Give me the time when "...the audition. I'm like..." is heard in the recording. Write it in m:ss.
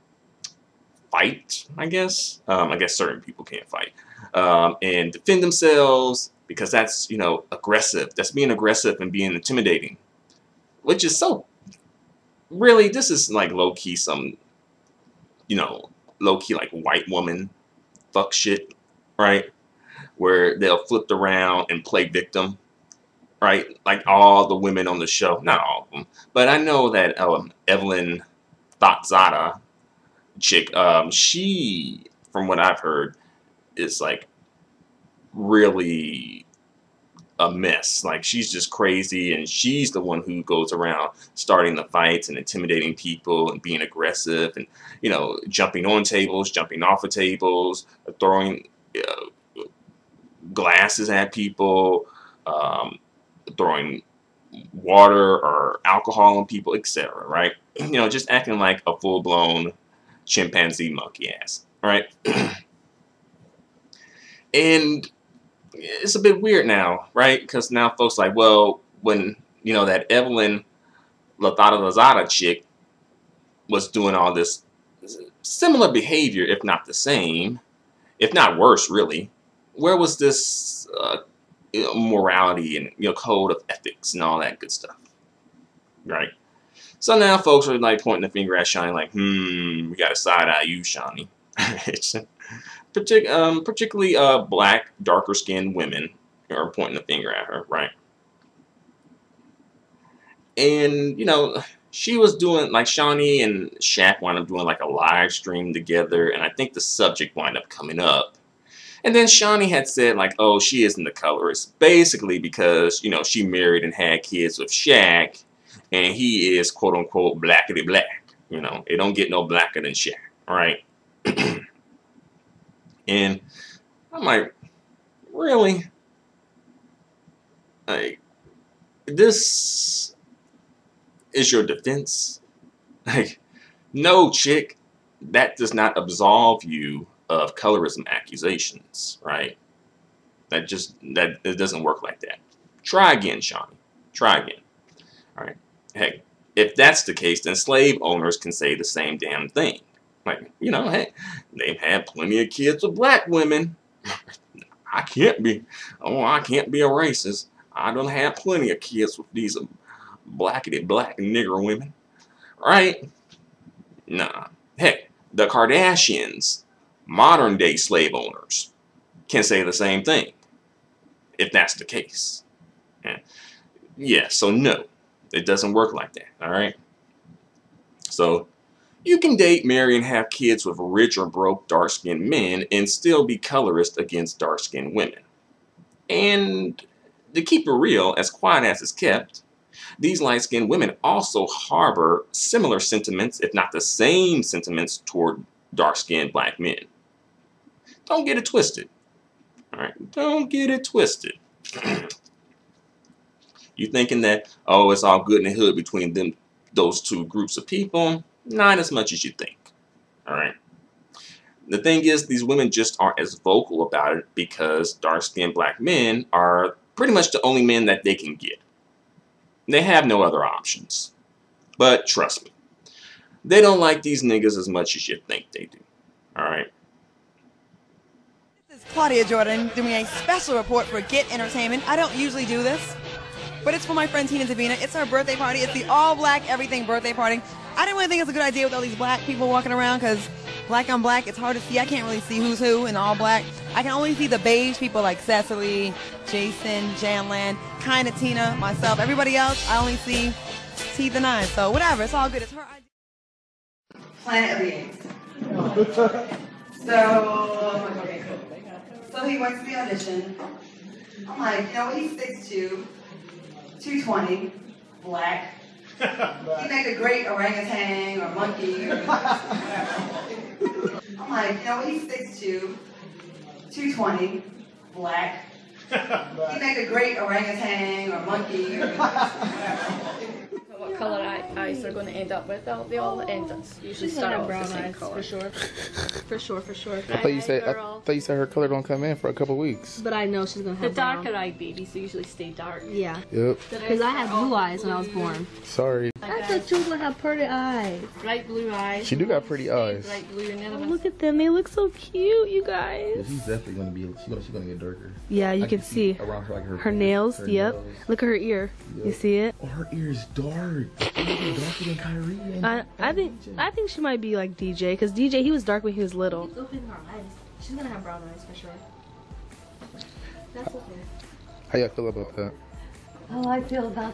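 4:19.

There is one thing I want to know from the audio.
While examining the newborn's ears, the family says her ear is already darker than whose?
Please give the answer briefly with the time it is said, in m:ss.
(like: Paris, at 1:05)
Kyrie, at 5:11.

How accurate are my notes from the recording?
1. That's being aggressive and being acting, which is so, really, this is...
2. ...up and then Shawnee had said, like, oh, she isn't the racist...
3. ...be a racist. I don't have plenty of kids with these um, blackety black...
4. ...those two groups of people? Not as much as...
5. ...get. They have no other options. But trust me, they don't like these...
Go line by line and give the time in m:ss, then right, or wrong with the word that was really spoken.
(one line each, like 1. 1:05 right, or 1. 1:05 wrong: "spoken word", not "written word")
1. 0:08 wrong: "intimidating", not "acting"
2. 1:47 wrong: "colorist", not "racist"
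3. 2:36 right
4. 3:26 right
5. 3:38 right.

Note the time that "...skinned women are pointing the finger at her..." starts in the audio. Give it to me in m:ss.
1:35.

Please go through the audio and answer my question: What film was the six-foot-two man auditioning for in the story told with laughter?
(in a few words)
Planet of the Apes.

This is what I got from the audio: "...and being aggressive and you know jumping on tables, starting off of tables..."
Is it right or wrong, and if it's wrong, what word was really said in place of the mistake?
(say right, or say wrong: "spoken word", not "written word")
wrong: "jumping", not "starting".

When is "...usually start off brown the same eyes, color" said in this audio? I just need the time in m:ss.
4:43.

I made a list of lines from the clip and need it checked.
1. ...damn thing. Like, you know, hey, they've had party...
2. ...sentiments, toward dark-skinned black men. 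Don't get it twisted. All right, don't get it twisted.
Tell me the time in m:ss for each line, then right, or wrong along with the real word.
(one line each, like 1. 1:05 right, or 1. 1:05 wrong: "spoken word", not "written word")
1. 2:29 wrong: "plenty", not "party"
2. 3:14 right.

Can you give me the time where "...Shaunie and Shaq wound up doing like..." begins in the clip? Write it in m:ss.
1:42.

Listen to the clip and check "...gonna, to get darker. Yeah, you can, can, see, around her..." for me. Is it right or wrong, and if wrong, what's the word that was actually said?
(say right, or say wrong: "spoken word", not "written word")
right.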